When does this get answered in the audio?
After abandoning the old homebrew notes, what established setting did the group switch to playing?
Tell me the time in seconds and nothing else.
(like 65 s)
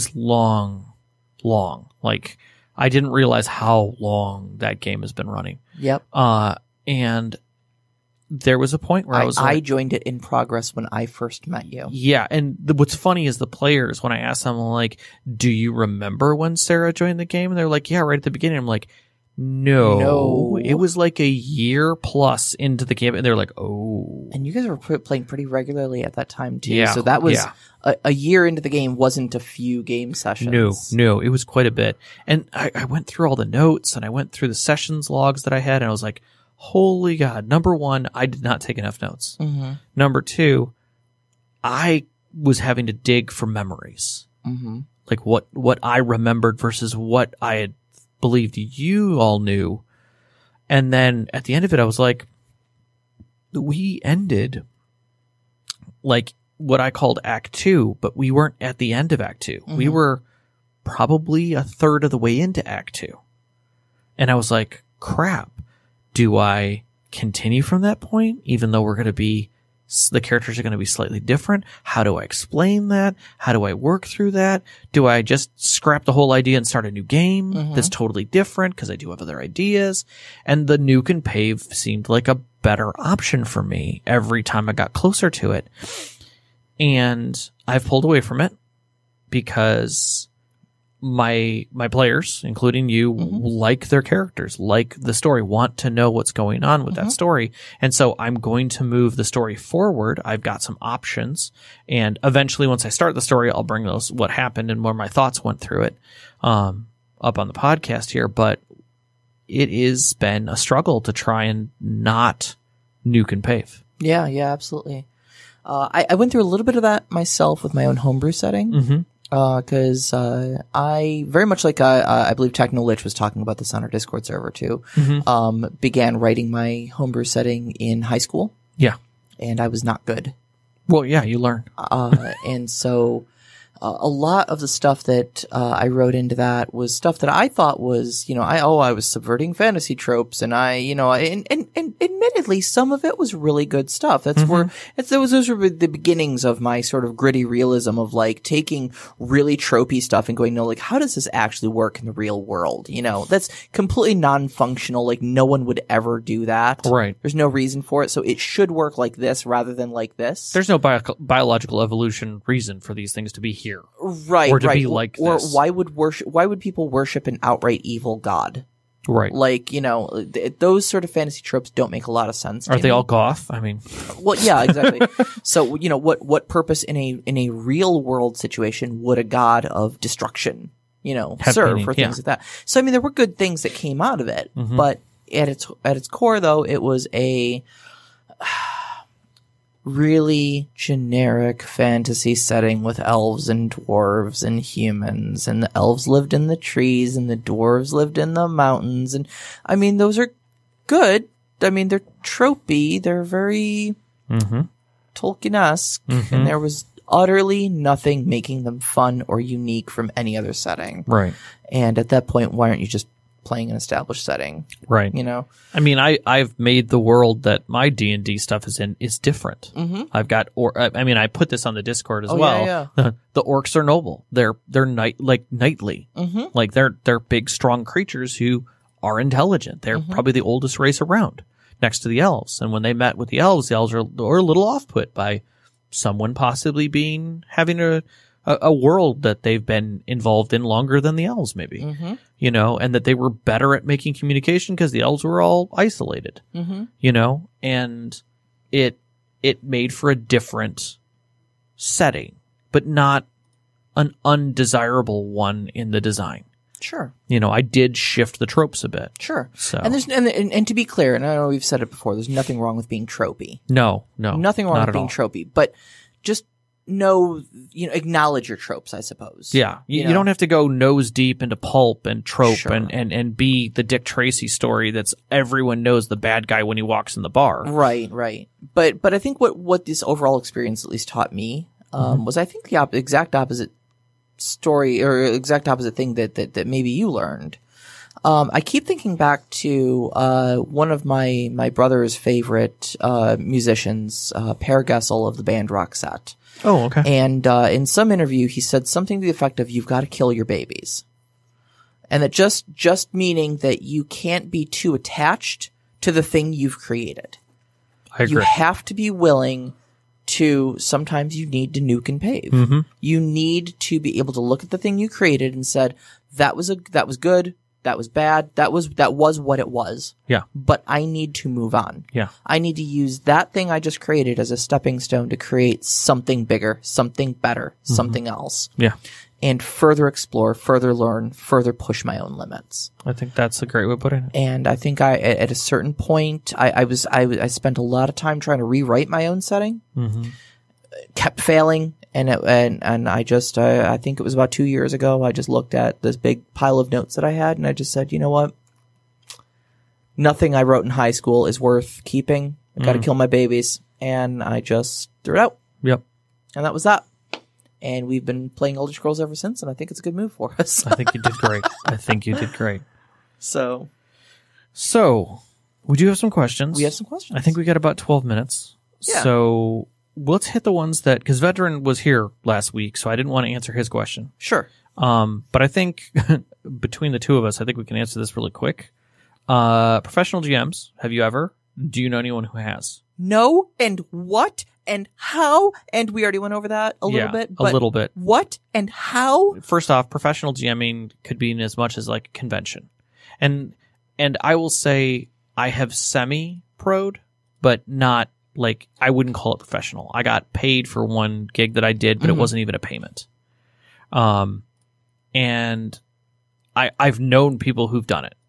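358 s.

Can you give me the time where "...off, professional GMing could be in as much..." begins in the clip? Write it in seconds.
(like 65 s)
389 s.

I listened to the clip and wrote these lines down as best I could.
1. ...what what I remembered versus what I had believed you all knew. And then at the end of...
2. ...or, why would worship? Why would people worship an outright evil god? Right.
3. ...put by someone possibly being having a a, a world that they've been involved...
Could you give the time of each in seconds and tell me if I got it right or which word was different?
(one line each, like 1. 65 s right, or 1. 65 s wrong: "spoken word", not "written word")
1. 45 s right
2. 165 s right
3. 234 s right.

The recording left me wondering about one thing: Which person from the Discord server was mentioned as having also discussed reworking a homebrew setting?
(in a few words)
Techno Lich.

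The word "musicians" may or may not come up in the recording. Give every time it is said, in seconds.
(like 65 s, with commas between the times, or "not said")
293 s.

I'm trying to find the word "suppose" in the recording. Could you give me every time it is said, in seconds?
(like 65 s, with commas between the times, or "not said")
268 s.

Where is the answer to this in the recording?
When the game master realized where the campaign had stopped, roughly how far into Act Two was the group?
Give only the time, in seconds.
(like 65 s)
61 s.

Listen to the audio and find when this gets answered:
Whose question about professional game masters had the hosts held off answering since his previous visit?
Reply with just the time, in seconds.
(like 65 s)
371 s.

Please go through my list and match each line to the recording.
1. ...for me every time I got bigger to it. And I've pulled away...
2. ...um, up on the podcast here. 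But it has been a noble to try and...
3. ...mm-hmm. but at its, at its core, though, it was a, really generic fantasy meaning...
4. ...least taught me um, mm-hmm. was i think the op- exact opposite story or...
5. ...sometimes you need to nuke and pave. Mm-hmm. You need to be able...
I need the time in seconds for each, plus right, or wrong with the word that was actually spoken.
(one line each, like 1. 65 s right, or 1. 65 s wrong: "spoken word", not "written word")
1. 83 s wrong: "closer", not "bigger"
2. 106 s wrong: "struggle", not "noble"
3. 184 s wrong: "setting", not "meaning"
4. 280 s right
5. 310 s right.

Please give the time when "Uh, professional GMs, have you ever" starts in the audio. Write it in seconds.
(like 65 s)
379 s.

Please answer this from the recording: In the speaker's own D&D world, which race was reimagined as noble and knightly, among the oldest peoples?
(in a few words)
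orcs.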